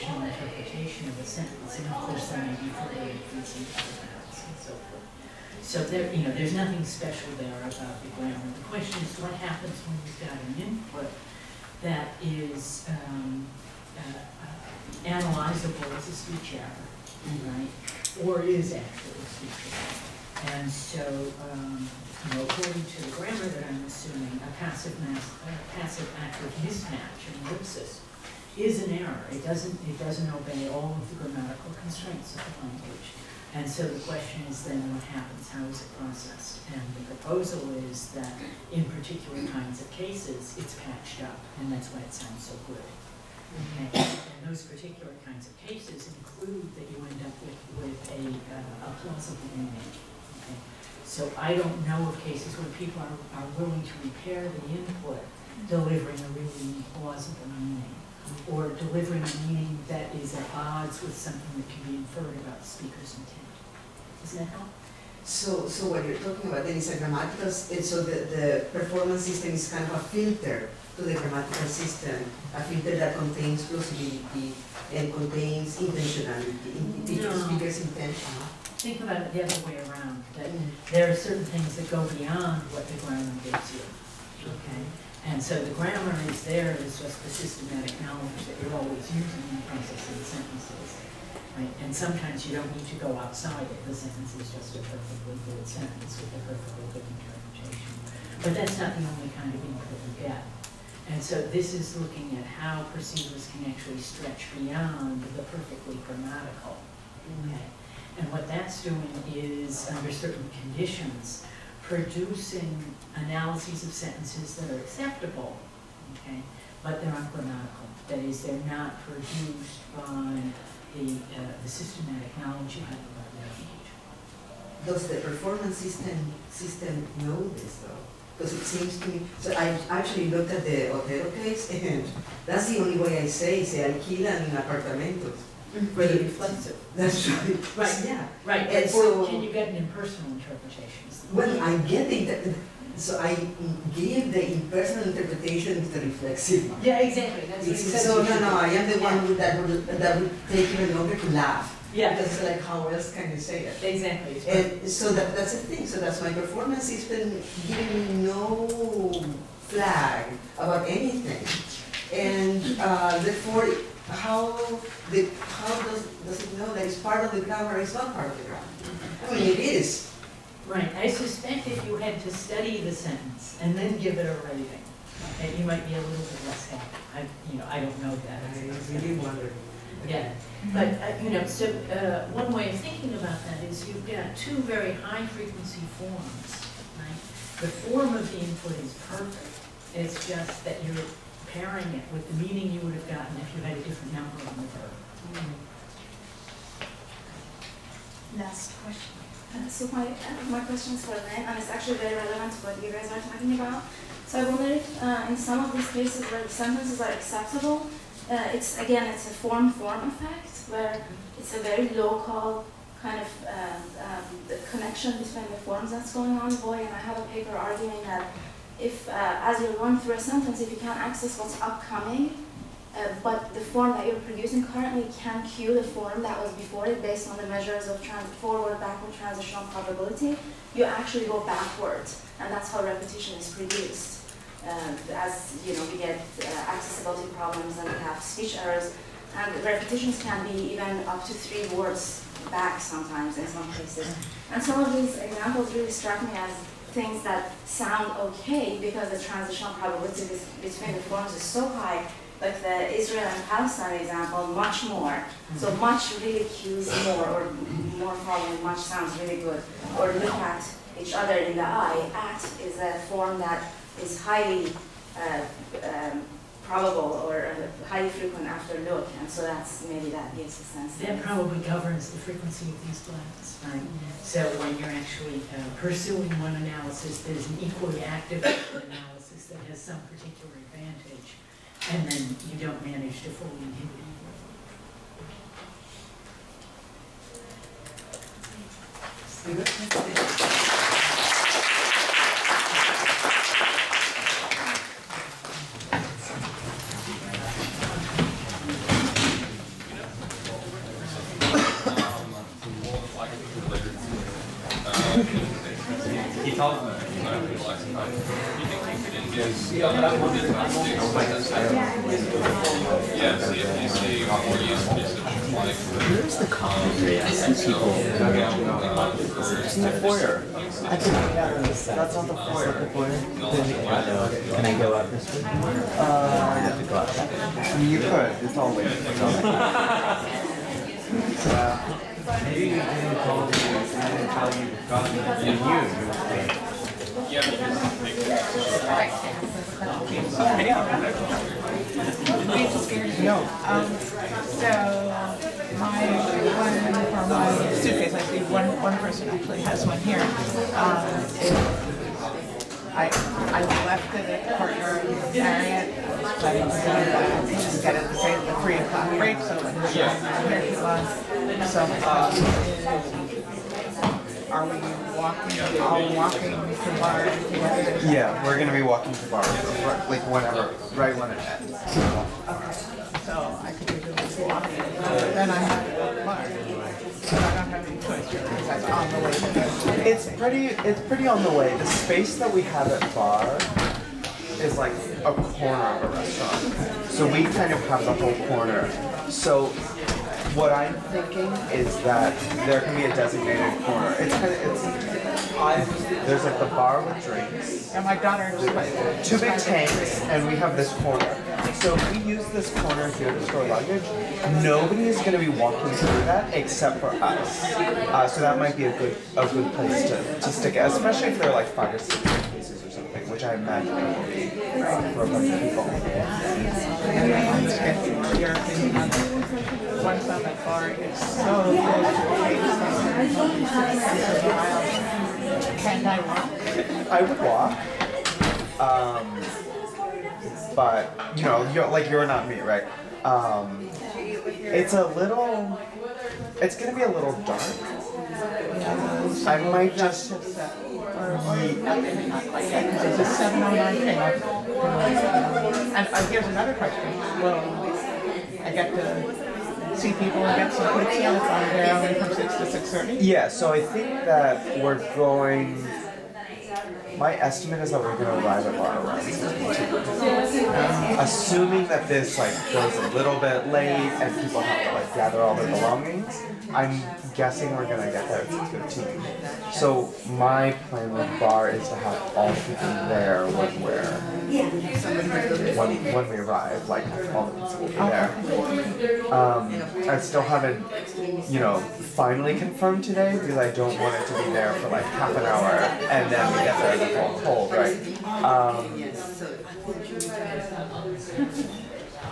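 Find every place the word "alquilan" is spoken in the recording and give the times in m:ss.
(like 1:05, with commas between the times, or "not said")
2:13.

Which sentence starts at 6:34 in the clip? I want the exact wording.
It's kind of, it's, I'm, there's like the bar with drinks.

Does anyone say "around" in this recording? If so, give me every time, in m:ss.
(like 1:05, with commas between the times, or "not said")
1:19, 7:39.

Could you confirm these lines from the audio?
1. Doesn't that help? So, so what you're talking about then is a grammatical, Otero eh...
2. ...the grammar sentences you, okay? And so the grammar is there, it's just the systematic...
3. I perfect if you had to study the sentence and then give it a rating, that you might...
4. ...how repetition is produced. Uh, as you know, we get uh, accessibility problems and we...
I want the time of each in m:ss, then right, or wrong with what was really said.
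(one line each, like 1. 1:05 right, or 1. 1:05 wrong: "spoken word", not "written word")
1. 1:04 wrong: "And", not "Otero"
2. 1:22 wrong: "gives", not "sentences"
3. 2:50 wrong: "suspect", not "perfect"
4. 3:52 right.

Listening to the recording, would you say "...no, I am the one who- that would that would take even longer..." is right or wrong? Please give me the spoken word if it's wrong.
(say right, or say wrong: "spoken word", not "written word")
right.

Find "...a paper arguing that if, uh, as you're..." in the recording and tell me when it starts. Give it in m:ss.
3:37.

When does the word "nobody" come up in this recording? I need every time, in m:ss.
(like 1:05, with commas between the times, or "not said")
6:44.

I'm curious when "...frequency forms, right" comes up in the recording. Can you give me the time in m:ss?
3:05.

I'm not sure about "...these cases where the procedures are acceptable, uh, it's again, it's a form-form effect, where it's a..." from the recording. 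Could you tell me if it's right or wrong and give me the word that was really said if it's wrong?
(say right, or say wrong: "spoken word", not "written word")
wrong: "sentences", not "procedures".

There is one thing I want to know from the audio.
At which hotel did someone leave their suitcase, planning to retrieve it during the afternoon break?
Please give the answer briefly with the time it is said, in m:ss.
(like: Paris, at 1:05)
the Marriott, at 5:54.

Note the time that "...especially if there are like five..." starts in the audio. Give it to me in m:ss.
6:50.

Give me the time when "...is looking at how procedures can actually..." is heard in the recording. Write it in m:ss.
1:41.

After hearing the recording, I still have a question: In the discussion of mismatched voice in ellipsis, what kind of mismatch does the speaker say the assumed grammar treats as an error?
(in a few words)
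passive active mismatch.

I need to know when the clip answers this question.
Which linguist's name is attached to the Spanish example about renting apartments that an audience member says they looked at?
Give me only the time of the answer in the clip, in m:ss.
2:10.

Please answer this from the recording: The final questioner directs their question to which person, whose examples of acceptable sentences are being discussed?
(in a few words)
Lyn.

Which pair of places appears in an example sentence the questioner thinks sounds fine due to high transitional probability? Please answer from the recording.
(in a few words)
Israel and Palestine.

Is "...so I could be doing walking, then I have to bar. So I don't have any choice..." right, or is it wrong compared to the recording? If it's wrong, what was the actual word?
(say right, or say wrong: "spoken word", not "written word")
right.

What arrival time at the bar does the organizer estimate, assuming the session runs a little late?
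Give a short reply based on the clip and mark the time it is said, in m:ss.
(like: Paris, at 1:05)
6:15, at 7:48.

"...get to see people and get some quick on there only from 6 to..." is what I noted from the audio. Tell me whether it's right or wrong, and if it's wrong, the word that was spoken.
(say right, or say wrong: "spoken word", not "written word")
right.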